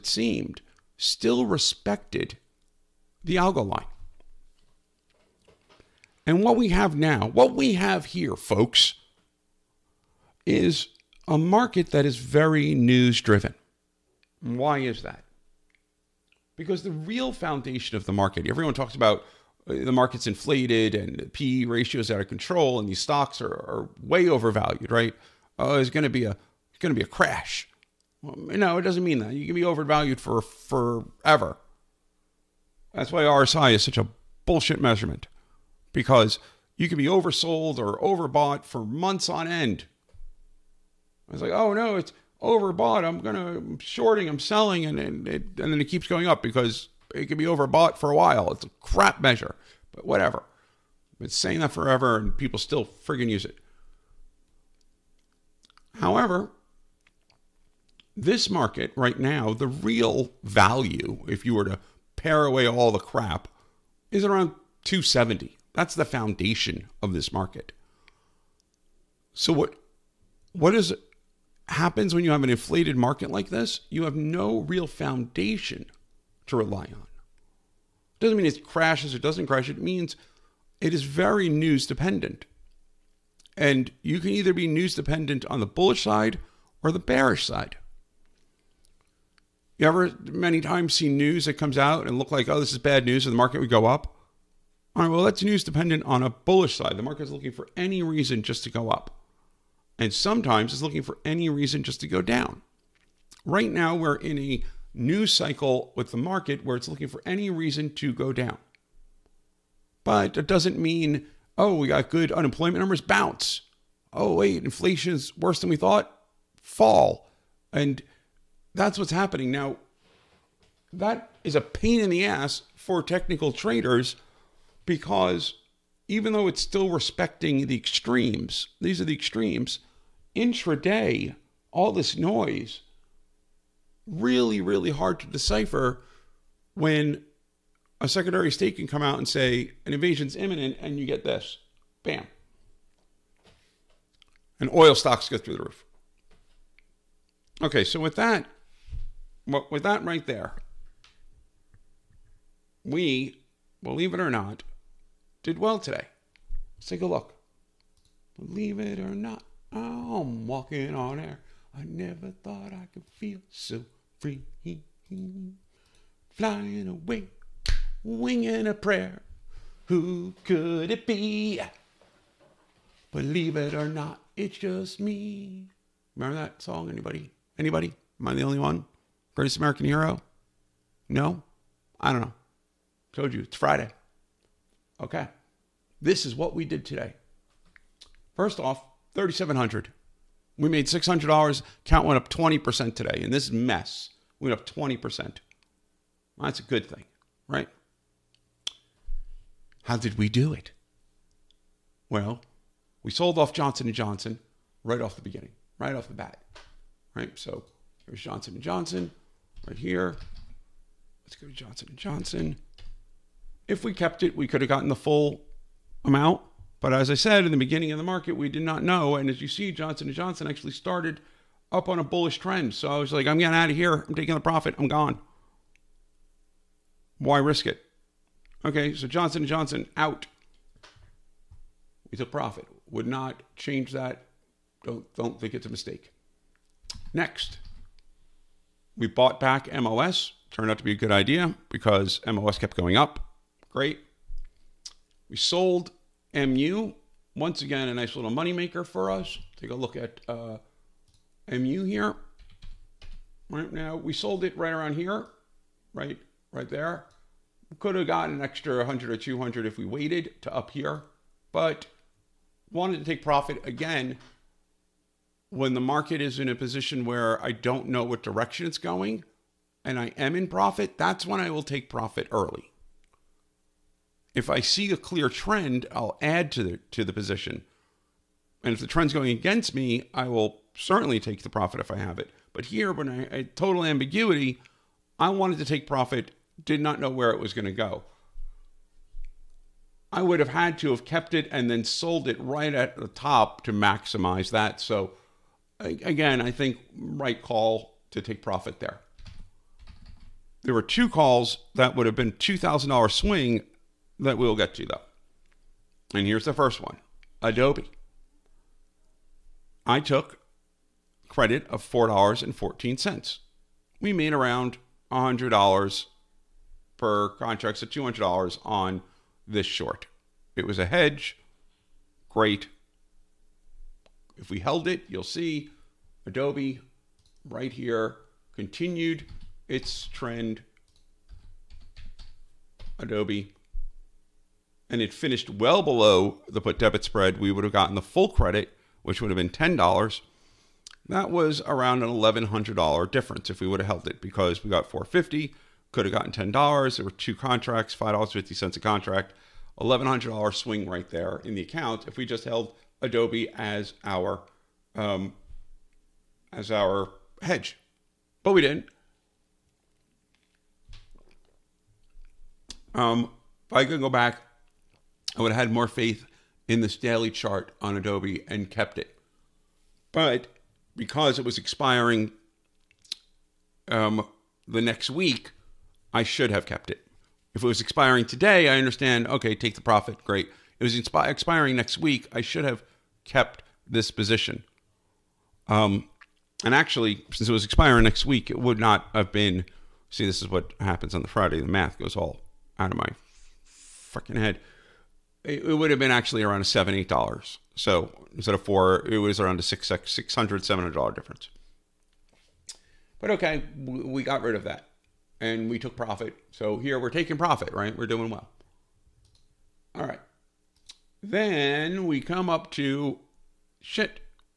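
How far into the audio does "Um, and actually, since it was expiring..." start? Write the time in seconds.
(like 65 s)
385 s.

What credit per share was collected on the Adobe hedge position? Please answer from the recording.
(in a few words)
$4.14.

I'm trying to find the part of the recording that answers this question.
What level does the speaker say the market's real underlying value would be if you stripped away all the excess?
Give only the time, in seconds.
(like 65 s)
64 s.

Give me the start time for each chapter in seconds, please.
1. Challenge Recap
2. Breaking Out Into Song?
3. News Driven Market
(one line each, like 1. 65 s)
1. 188 s
2. 156 s
3. 13 s.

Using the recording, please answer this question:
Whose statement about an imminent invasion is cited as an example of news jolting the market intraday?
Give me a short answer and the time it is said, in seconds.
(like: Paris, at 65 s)
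Secretary of State, at 138 s.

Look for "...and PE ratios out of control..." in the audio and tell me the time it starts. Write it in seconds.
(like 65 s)
20 s.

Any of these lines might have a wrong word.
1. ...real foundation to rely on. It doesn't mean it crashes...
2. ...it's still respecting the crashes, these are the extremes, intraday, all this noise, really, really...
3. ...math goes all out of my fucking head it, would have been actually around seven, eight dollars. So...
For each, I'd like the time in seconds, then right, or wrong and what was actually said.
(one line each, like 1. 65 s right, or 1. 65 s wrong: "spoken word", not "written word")
1. 74 s right
2. 126 s wrong: "extremes", not "crashes"
3. 391 s right.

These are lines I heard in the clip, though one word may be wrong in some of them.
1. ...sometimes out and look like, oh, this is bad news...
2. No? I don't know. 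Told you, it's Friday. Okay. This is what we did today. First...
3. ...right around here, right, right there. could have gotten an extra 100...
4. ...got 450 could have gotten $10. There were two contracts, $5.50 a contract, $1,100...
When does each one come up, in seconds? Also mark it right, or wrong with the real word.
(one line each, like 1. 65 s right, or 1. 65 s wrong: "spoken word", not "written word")
1. 91 s wrong: "comes", not "sometimes"
2. 181 s right
3. 254 s right
4. 344 s right.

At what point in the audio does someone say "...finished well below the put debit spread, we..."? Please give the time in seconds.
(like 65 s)
335 s.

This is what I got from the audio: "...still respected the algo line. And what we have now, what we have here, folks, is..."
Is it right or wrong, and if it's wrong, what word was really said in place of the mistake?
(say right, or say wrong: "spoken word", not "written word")
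right.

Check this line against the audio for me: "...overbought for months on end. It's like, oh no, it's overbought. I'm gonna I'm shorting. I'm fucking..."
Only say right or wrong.
wrong.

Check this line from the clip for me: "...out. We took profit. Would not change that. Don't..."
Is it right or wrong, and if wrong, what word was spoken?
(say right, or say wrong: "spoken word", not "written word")
right.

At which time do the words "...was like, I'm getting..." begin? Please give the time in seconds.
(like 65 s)
222 s.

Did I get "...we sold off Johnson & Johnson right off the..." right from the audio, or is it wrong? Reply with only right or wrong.
right.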